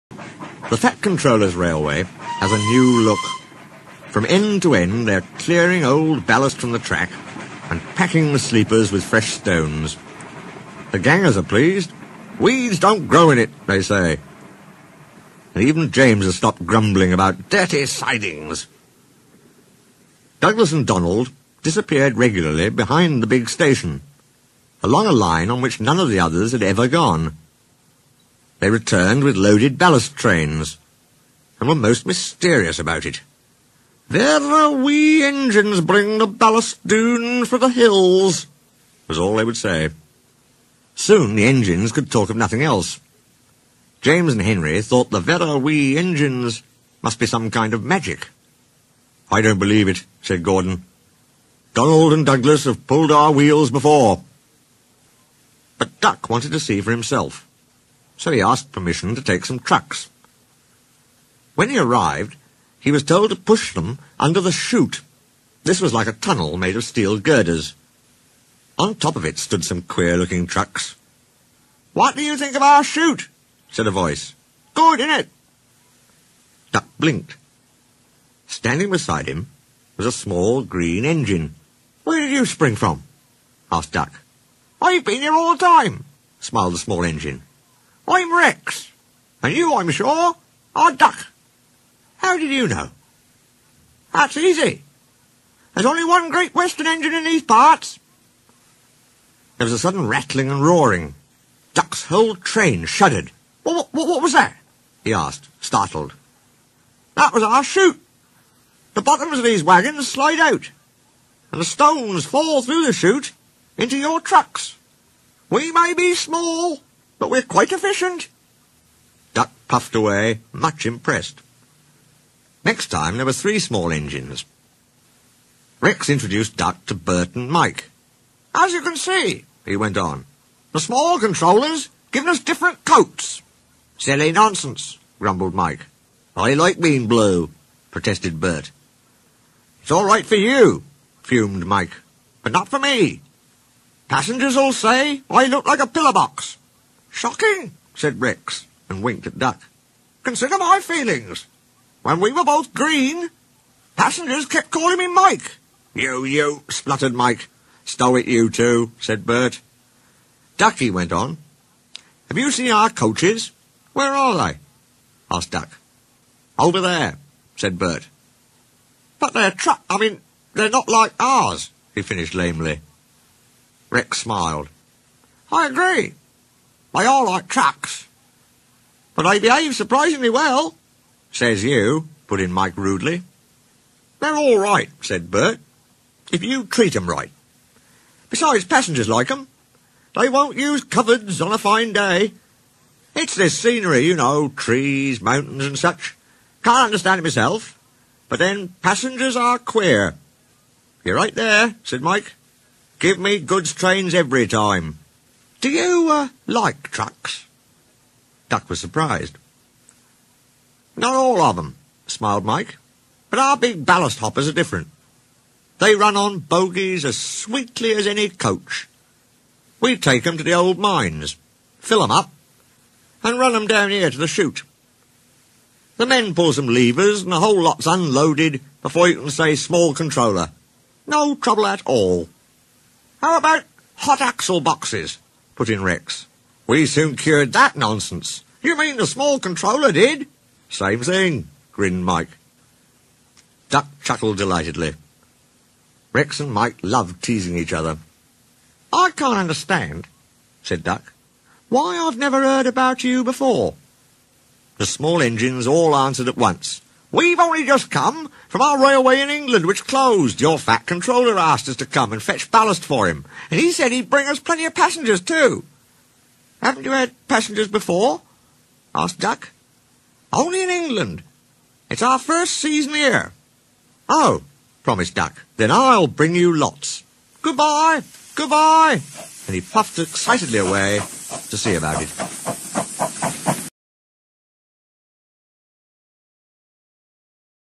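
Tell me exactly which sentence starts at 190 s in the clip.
They won't use cupboards on a fine day.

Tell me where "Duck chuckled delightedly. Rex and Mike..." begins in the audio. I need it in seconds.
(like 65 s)
243 s.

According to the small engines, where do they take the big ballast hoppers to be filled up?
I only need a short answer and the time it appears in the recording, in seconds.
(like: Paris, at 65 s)
The old mines, at 220 s.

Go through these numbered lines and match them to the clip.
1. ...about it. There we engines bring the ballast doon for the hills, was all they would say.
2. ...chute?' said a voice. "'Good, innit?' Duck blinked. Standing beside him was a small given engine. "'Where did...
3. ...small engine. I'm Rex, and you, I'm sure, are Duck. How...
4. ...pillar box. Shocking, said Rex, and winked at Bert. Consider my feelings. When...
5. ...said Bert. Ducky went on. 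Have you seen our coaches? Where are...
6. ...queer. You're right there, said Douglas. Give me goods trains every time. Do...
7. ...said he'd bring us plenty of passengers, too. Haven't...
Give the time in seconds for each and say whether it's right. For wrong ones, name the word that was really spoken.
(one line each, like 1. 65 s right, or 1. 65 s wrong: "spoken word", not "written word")
1. 32 s right
2. 72 s wrong: "green", not "given"
3. 86 s right
4. 145 s wrong: "Duck", not "Bert"
5. 158 s right
6. 199 s wrong: "Mike", not "Douglas"
7. 263 s right.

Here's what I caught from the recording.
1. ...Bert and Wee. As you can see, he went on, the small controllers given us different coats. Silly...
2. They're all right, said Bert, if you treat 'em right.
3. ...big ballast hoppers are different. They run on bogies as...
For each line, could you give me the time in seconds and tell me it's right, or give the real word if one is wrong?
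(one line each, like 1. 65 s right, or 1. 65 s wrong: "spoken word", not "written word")
1. 126 s wrong: "Mike", not "Wee"
2. 184 s right
3. 213 s right.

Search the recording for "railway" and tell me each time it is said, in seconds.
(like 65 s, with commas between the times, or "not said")
1 s, 258 s.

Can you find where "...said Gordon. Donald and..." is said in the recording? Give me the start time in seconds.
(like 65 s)
50 s.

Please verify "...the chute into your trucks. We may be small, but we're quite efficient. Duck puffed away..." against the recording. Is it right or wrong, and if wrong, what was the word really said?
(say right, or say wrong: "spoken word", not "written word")
right.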